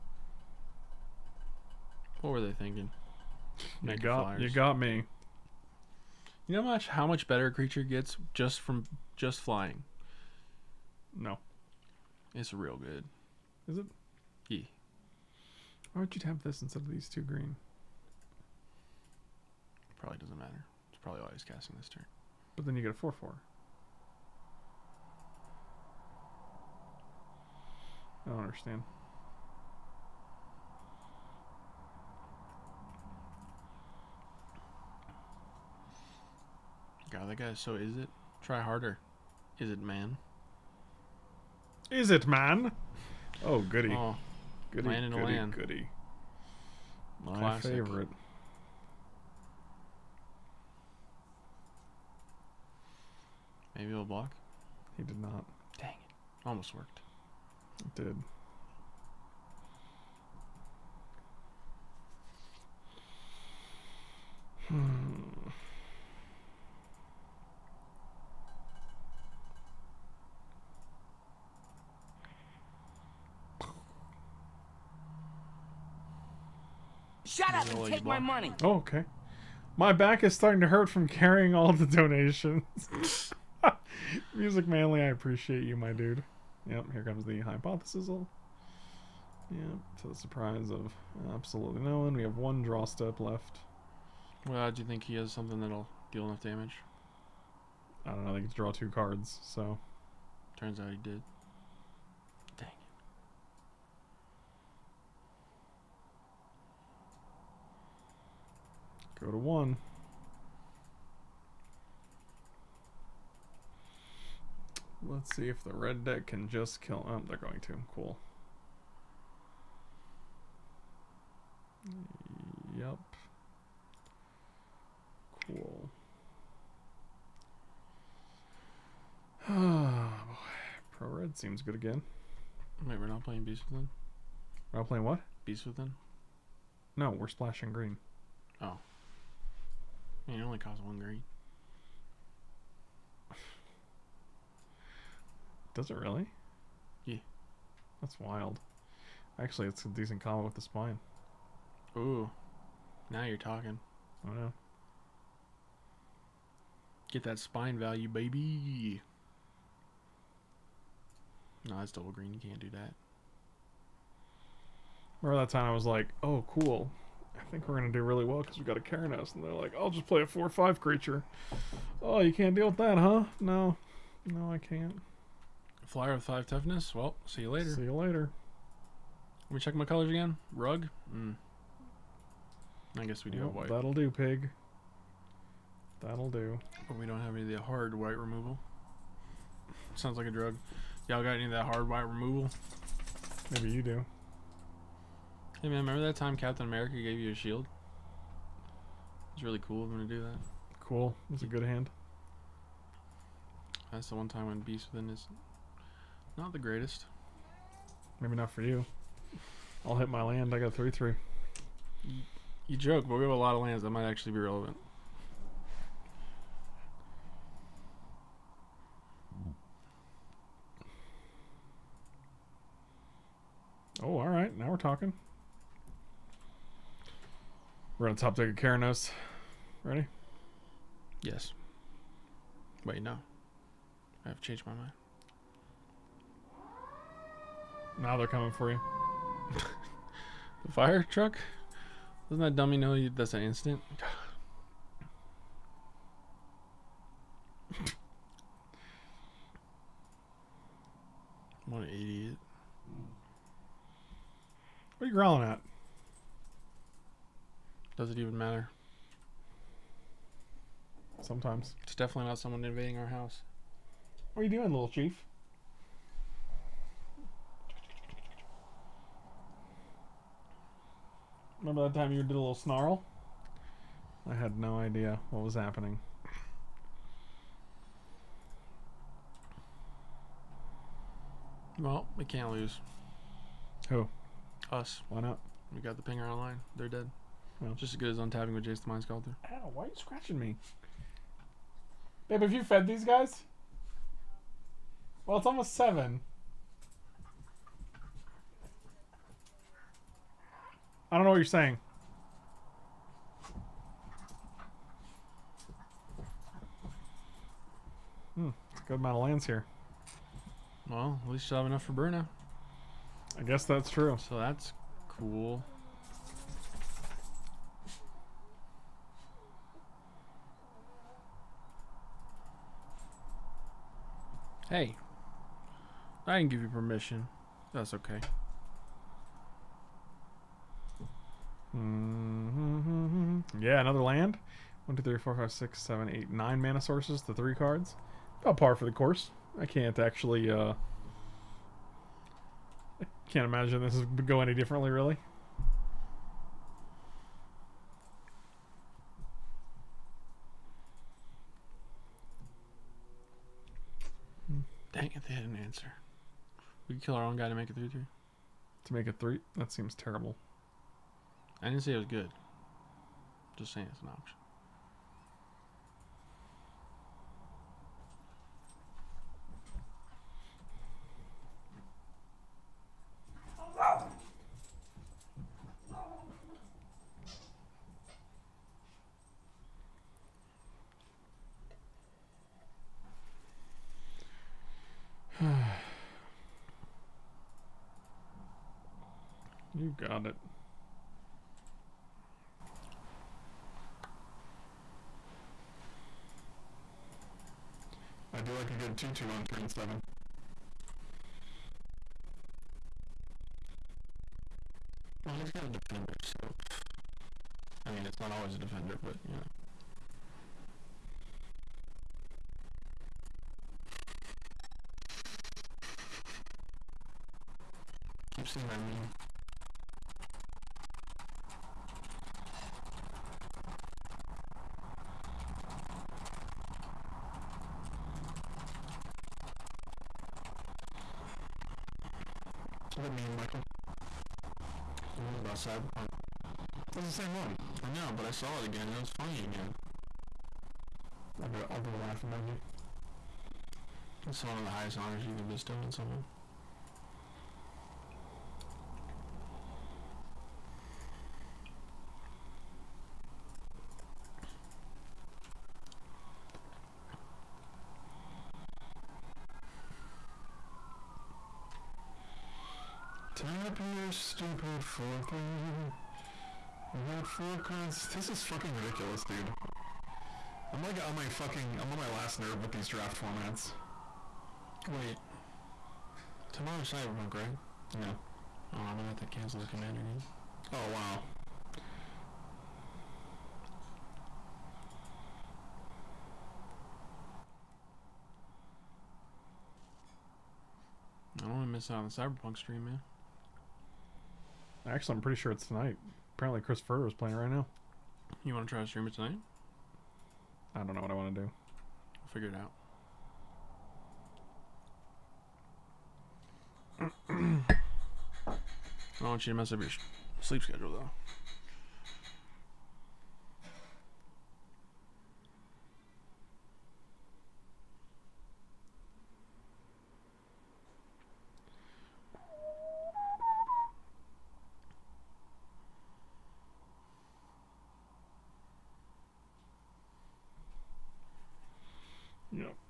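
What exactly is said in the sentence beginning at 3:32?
you joke, but we have a lot of lands.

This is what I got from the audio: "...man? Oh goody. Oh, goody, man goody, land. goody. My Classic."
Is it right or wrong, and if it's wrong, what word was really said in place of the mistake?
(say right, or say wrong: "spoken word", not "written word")
right.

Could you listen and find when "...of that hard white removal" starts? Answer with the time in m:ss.
3:11.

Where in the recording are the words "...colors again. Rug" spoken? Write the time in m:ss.
2:59.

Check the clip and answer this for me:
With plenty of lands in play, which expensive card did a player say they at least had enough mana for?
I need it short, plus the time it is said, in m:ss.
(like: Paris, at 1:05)
Bruna, at 5:11.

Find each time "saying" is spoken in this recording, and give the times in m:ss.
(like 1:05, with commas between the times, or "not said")
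5:01, 6:03.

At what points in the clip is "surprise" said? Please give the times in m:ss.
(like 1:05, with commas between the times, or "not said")
1:30.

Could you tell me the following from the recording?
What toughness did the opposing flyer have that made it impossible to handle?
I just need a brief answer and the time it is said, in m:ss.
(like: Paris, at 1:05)
5, at 2:56.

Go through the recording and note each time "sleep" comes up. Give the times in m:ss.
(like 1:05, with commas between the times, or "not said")
8:30.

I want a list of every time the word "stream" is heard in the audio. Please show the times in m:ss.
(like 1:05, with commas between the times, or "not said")
8:12, 8:18.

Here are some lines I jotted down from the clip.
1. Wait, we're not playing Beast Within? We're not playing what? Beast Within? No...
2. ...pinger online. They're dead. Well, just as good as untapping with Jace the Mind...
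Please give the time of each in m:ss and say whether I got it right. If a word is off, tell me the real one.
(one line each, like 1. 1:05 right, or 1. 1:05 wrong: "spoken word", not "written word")
1. 2:12 right
2. 4:46 right.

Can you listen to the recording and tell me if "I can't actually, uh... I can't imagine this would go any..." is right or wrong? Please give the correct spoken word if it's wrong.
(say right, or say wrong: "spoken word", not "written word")
right.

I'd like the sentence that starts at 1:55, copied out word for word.
Let's see if the red deck can just kill.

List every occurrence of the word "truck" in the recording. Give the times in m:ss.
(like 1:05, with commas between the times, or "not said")
4:01.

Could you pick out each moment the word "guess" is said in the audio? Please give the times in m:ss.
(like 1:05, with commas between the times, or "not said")
3:03, 5:13.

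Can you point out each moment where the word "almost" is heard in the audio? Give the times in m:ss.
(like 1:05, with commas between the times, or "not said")
0:56, 4:55.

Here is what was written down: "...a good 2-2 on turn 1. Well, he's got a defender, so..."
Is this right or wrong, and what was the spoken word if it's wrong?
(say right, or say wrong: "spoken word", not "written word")
wrong: "7", not "1".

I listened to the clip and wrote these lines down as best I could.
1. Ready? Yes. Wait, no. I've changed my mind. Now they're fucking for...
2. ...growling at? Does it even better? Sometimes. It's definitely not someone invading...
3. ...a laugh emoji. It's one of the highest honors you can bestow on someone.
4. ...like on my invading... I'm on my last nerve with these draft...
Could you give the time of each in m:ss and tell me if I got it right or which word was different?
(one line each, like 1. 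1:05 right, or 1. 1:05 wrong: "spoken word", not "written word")
1. 3:49 wrong: "coming", not "fucking"
2. 4:15 wrong: "matter", not "better"
3. 7:21 right
4. 7:50 wrong: "fucking", not "invading".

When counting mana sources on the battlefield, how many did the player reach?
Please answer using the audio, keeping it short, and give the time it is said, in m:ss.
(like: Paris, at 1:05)
9, at 5:36.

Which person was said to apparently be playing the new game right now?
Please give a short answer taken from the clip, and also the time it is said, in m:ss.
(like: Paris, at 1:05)
Chris Furr, at 8:16.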